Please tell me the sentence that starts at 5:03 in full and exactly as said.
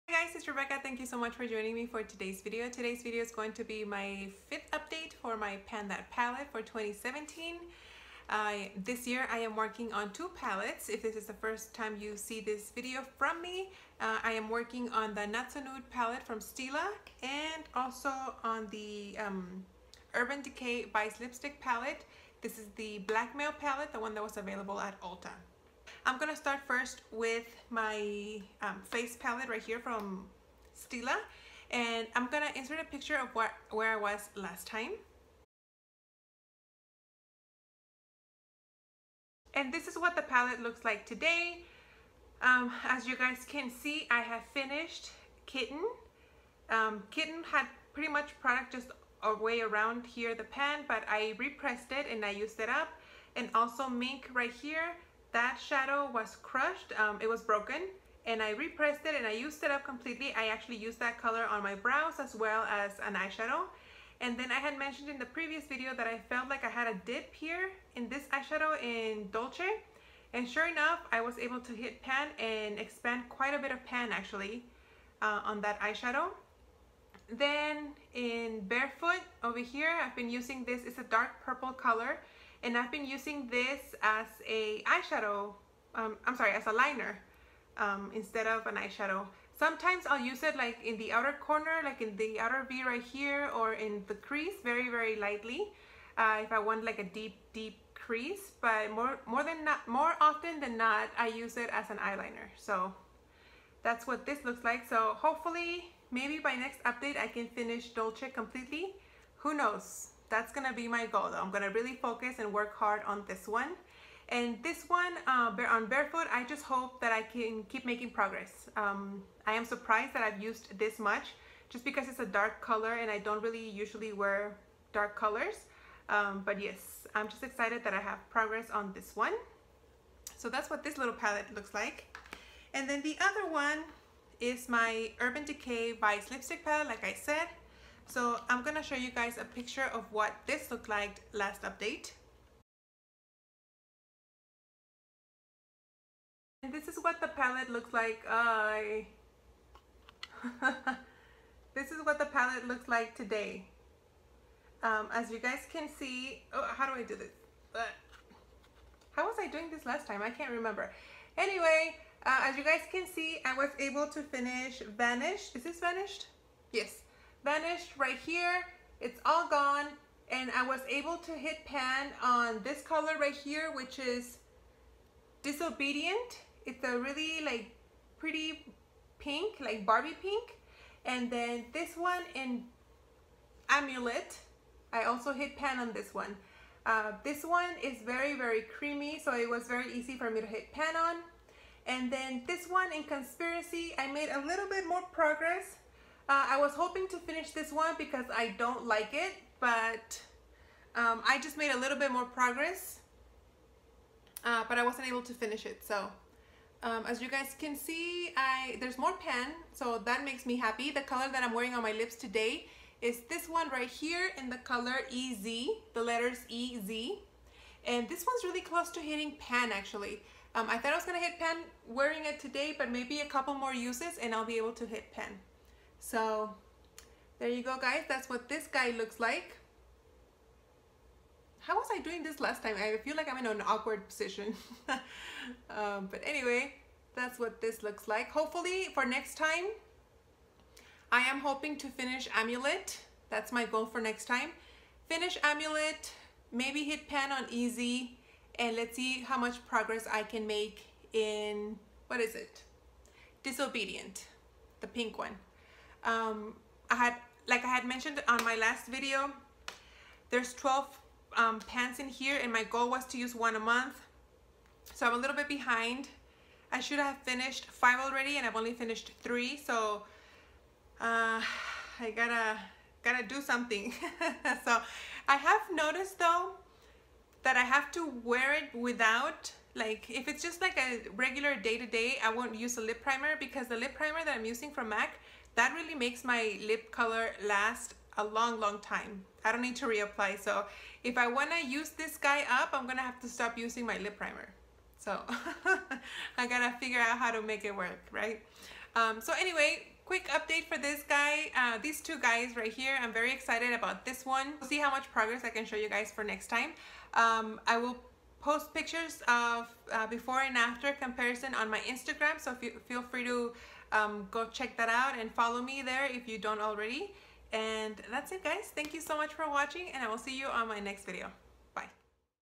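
I'm very excited about this one.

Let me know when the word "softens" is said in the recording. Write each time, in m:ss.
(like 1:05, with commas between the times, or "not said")
not said.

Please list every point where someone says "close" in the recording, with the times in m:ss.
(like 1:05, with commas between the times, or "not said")
3:38.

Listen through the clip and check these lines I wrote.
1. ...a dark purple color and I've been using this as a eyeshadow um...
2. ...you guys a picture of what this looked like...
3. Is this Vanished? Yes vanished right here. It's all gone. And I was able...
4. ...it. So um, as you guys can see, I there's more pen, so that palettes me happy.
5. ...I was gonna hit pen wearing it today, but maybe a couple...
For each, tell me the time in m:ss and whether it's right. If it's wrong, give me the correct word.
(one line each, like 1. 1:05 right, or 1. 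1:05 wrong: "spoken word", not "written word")
1. 1:20 right
2. 2:18 right
3. 2:45 right
4. 3:25 wrong: "makes", not "palettes"
5. 3:40 right.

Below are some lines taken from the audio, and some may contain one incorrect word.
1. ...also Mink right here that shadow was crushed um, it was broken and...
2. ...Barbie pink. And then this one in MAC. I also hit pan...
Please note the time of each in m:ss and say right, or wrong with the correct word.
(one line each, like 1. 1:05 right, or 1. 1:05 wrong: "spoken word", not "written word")
1. 0:53 right
2. 2:59 wrong: "Amulet", not "MAC".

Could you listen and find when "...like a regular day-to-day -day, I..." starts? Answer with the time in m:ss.
4:40.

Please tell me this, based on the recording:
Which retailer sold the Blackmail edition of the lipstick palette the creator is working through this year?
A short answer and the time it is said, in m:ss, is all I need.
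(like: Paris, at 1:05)
Ulta, at 0:25.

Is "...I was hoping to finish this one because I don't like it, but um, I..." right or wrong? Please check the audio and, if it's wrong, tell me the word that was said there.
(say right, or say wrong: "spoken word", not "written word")
right.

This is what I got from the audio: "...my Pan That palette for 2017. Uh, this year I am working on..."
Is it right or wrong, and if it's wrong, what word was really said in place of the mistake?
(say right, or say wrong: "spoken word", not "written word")
right.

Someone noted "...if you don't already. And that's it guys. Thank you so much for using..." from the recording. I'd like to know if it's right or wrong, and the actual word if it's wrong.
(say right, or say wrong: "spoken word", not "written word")
wrong: "watching", not "using".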